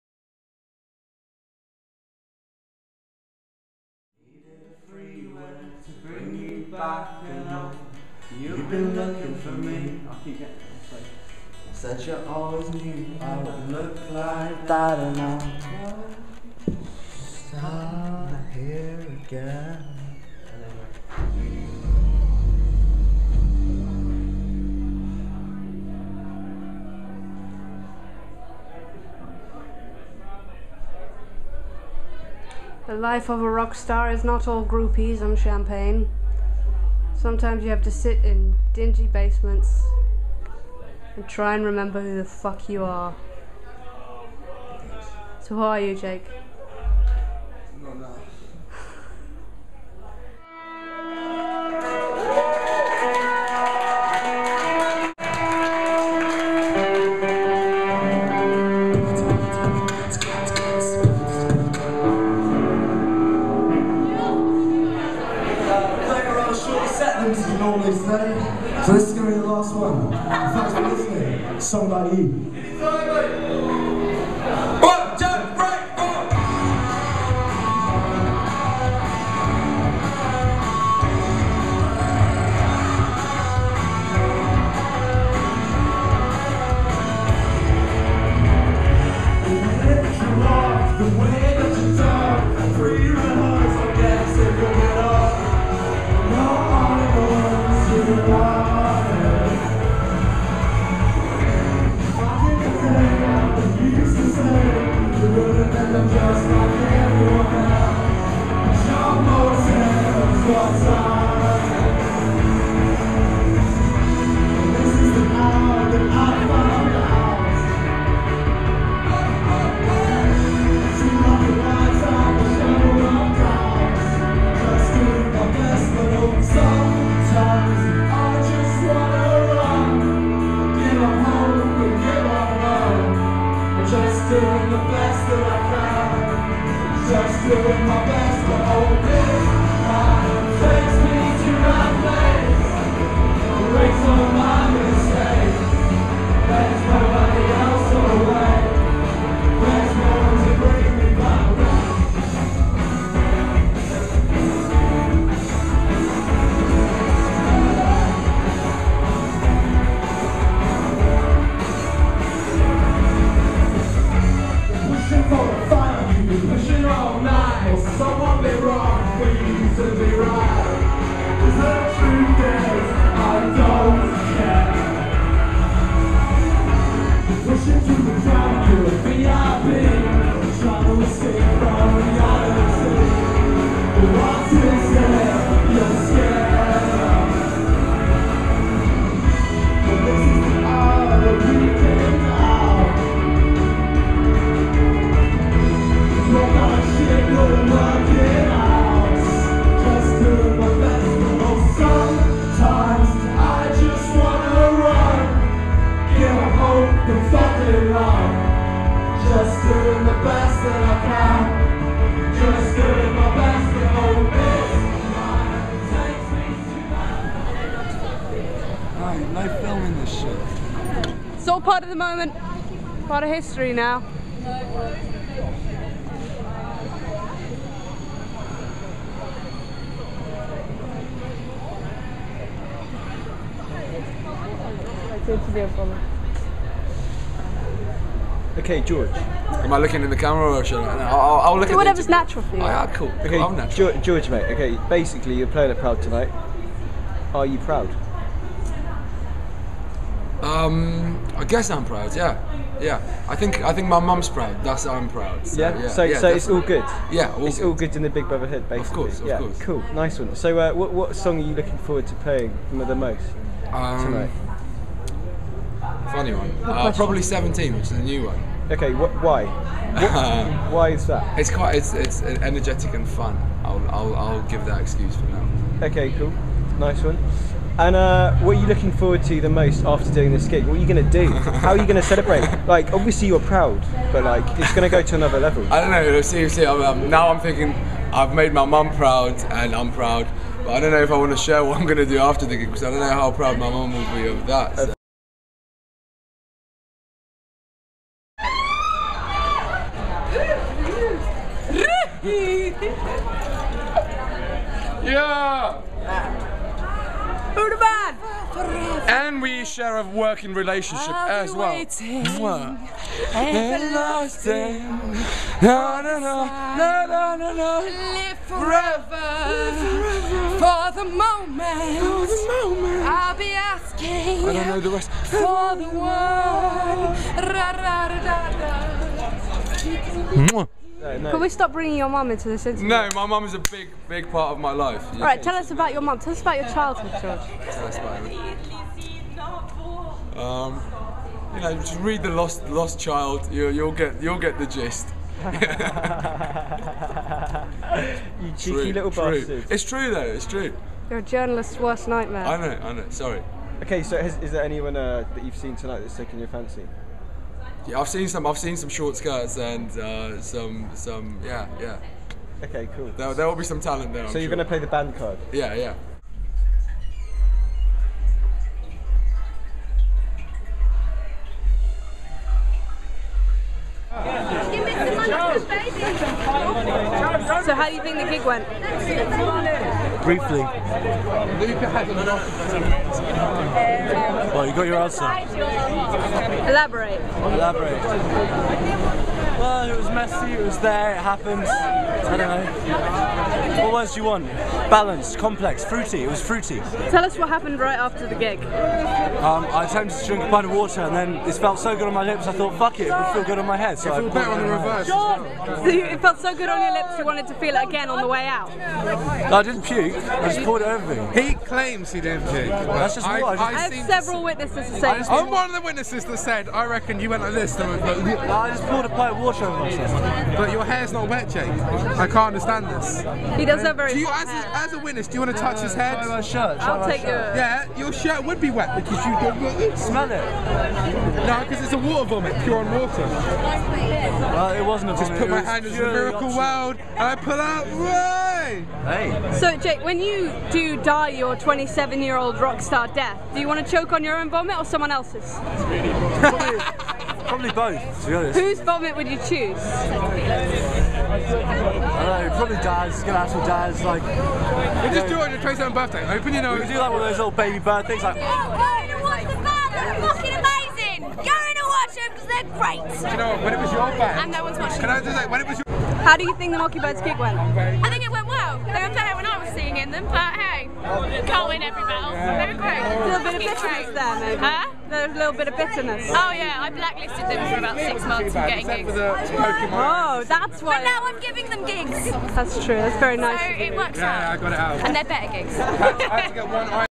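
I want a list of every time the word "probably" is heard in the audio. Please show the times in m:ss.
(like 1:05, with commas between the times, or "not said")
4:26, 7:27, 7:32.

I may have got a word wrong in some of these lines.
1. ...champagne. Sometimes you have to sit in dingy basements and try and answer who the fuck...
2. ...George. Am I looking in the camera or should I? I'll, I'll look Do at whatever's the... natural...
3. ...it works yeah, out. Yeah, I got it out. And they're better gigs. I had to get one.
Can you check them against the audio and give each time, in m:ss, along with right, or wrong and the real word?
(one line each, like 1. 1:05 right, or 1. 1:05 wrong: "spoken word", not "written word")
1. 0:35 wrong: "remember", not "answer"
2. 3:58 right
3. 8:03 right.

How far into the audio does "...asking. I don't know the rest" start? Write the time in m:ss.
5:23.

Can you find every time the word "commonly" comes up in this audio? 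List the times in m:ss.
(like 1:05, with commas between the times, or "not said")
not said.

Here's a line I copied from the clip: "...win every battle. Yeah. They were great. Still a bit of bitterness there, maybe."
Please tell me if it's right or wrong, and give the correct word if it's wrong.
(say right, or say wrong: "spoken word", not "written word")
right.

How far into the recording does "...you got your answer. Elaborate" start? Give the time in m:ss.
6:24.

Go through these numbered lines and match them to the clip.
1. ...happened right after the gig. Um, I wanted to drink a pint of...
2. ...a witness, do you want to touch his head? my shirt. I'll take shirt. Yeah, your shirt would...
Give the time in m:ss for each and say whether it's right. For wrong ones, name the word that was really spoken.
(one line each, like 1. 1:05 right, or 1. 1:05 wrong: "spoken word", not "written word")
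1. 6:37 wrong: "attempted", not "wanted"
2. 7:04 right.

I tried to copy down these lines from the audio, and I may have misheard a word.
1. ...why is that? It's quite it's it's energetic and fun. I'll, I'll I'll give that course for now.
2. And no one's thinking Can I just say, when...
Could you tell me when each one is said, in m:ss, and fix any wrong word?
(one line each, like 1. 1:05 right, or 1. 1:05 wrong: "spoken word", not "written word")
1. 4:30 wrong: "excuse", not "course"
2. 7:44 wrong: "watching", not "thinking".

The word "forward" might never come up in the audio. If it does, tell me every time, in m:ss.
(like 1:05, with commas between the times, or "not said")
4:21, 4:38.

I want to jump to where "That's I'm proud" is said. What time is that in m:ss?
4:14.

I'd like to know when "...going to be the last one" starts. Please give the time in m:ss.
1:09.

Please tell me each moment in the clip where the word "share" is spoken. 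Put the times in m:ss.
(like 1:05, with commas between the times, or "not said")
4:51, 5:09.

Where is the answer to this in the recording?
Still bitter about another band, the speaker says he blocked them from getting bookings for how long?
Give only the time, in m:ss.
7:57.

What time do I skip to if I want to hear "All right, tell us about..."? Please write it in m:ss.
5:35.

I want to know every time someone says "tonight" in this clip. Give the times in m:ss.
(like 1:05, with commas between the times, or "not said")
4:06, 4:24, 5:55.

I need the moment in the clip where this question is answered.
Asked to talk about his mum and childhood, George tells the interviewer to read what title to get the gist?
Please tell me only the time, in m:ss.
5:42.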